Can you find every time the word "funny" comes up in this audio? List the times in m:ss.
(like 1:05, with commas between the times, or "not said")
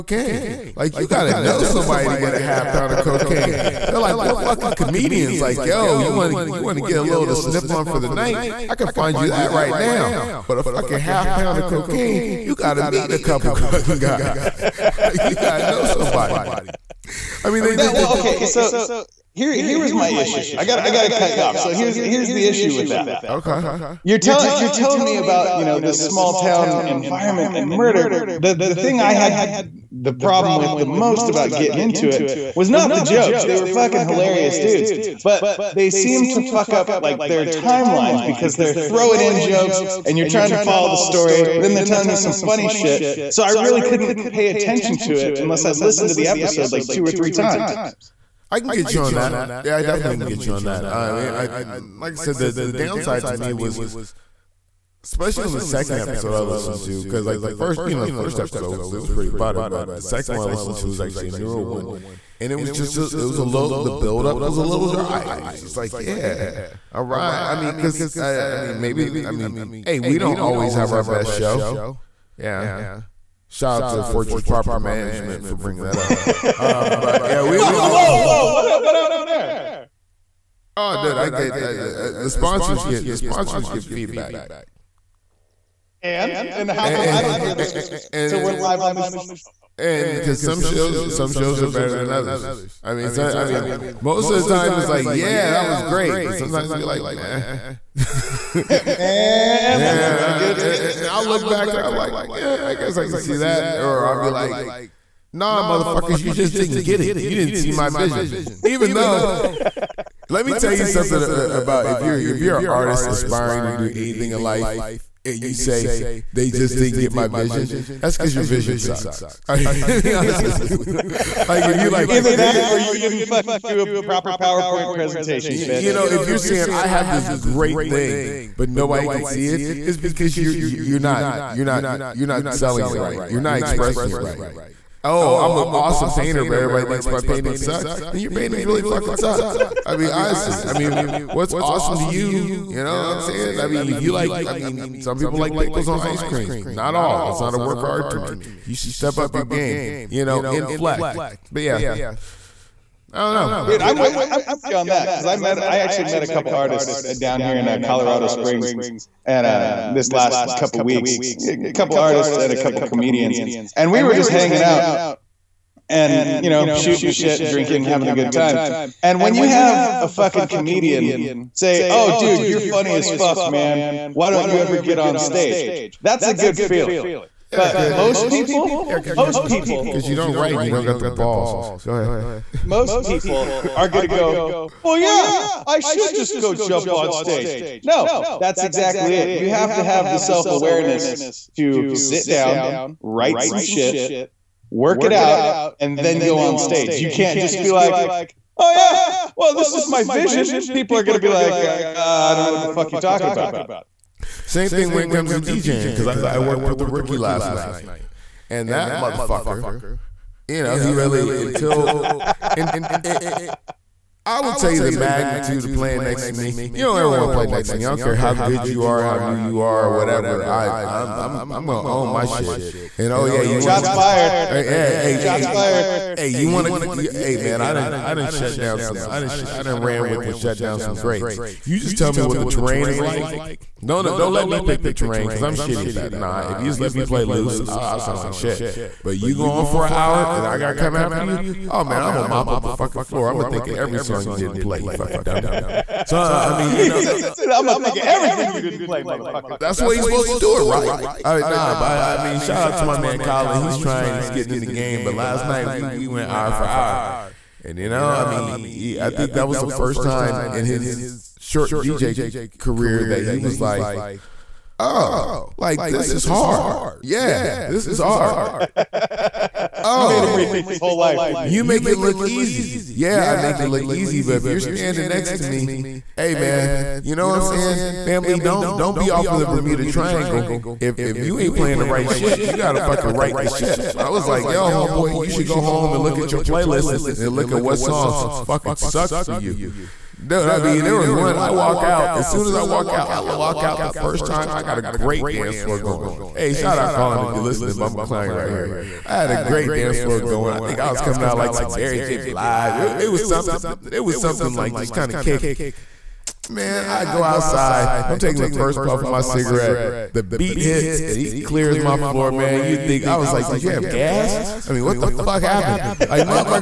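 0:42, 2:52.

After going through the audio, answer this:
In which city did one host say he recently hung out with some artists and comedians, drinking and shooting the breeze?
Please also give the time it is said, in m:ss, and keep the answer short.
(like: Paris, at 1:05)
Colorado Springs, at 2:37.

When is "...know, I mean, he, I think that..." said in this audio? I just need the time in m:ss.
4:17.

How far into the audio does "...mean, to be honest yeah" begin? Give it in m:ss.
1:59.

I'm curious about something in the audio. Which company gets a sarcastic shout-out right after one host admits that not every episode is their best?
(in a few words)
Fortress Property Management.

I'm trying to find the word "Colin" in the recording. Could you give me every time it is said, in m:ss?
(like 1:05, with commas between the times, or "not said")
4:13, 4:56.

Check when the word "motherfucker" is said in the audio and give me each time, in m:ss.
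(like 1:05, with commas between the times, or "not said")
1:45, 3:28, 4:09.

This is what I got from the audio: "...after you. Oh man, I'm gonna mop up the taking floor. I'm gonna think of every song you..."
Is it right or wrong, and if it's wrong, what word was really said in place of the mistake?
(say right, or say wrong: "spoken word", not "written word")
wrong: "fucking", not "taking".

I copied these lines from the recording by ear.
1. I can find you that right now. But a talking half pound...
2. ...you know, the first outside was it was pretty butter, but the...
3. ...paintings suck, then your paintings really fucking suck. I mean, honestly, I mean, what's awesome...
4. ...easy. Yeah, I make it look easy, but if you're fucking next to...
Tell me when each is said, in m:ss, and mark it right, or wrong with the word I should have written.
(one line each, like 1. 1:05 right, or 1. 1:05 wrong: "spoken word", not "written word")
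1. 0:08 wrong: "fucking", not "talking"
2. 0:57 wrong: "episode", not "outside"
3. 2:17 right
4. 4:32 wrong: "standing", not "fucking".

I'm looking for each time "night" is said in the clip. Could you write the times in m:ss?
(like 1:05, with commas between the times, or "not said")
0:08, 3:27, 4:15.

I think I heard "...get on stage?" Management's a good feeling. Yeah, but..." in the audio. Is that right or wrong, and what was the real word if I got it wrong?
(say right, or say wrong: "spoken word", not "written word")
wrong: "That", not "Management".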